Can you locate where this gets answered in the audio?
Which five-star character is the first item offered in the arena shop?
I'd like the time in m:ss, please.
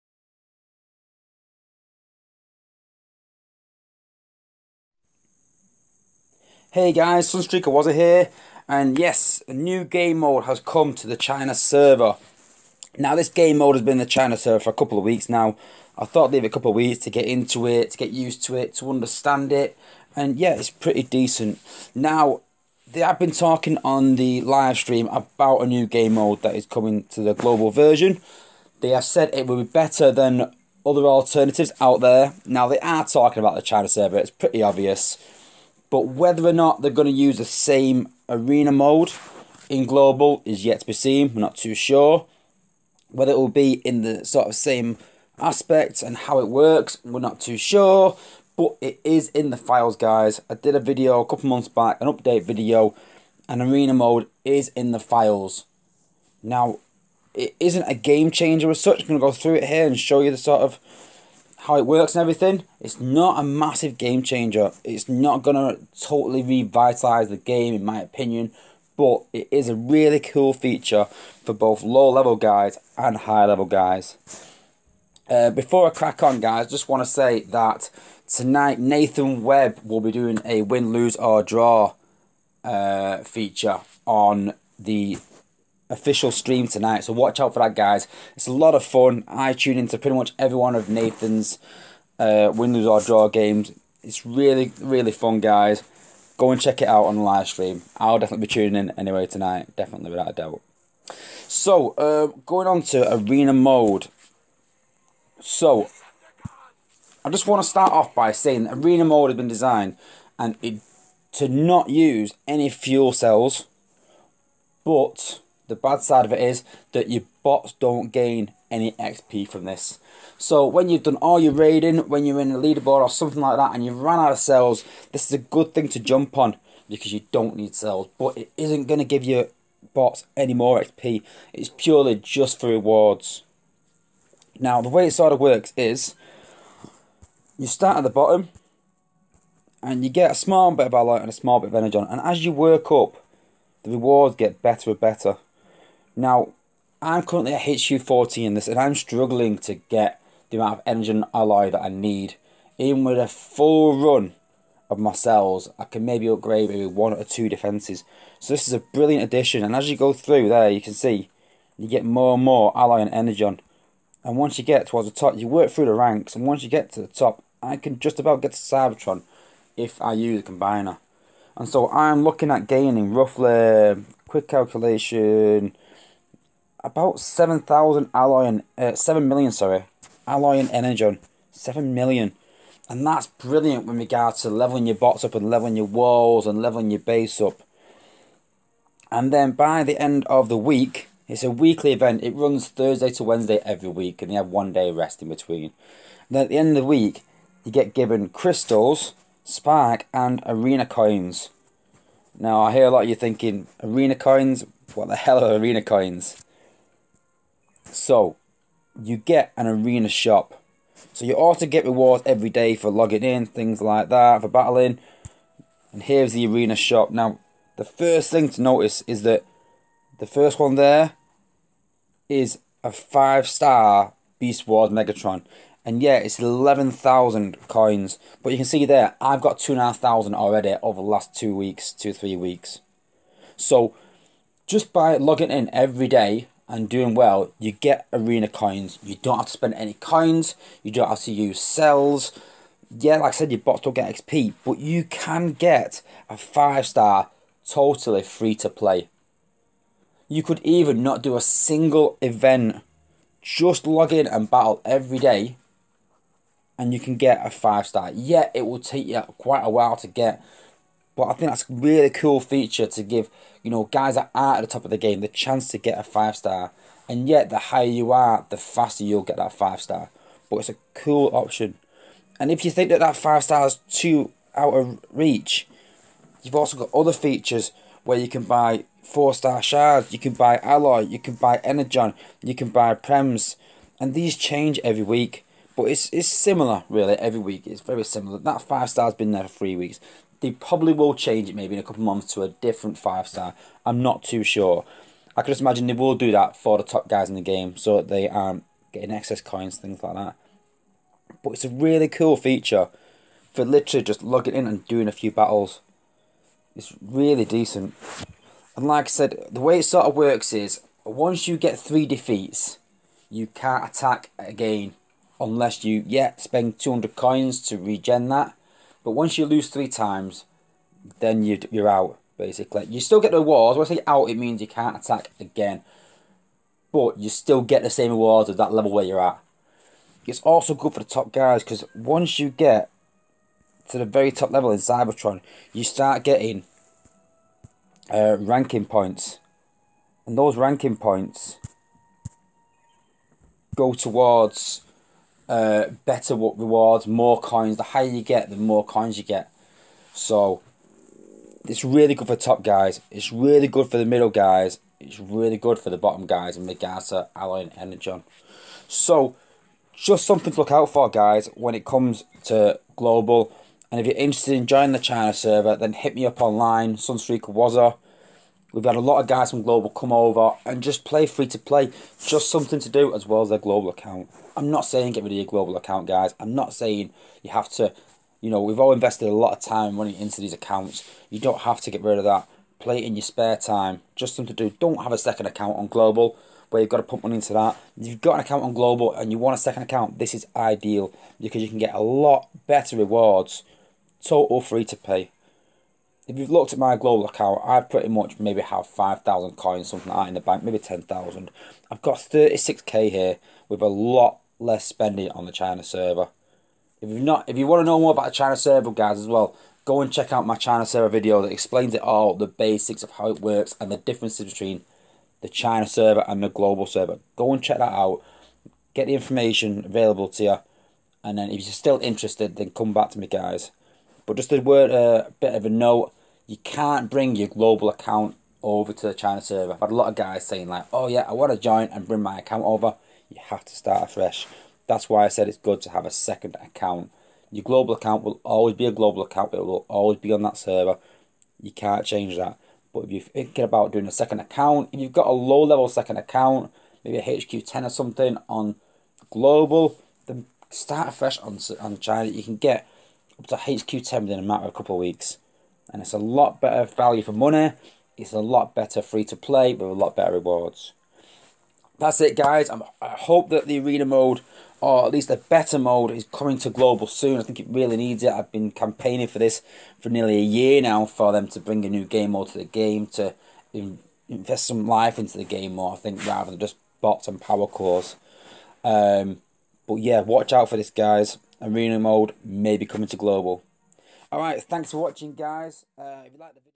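3:44.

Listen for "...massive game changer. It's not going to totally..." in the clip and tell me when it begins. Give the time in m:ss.
1:03.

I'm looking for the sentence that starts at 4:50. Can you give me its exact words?
They probably will change it maybe in a couple of months to a different five star.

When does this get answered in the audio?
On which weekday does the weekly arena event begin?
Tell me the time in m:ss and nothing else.
3:12.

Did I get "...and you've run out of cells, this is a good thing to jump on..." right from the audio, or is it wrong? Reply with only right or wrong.
right.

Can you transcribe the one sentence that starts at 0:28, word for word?
They have said it will be better than other alternatives out there.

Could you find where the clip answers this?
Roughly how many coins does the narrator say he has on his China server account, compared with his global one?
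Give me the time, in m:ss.
6:42.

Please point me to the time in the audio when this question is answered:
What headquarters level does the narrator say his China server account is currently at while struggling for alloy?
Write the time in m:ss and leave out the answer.
2:27.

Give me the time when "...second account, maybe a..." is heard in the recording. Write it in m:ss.
7:25.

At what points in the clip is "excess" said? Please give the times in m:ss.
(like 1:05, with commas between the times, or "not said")
4:59.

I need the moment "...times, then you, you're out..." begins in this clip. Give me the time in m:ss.
5:19.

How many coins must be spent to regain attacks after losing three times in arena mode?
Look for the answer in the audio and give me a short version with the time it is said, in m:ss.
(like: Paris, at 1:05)
200, at 5:16.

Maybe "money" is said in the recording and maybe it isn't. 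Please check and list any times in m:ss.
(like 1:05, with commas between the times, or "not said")
6:19, 6:27, 7:37.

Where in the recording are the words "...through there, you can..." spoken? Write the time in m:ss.
2:40.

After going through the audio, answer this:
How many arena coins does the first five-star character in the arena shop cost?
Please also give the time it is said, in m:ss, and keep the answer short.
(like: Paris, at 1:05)
11,000, at 3:46.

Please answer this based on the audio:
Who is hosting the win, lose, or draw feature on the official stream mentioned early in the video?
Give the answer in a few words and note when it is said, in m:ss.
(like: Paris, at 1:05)
Nathan Webb, at 1:18.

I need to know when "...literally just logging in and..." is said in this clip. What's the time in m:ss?
5:03.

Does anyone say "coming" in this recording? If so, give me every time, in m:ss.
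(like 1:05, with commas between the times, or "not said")
0:26, 7:46, 8:02.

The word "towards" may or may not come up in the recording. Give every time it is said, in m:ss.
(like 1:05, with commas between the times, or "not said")
2:44, 5:43.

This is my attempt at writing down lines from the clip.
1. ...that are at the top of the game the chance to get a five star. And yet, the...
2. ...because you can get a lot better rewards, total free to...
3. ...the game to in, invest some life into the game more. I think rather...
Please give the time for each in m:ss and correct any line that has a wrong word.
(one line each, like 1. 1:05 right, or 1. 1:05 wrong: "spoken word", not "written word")
1. 4:24 right
2. 6:31 right
3. 7:52 right.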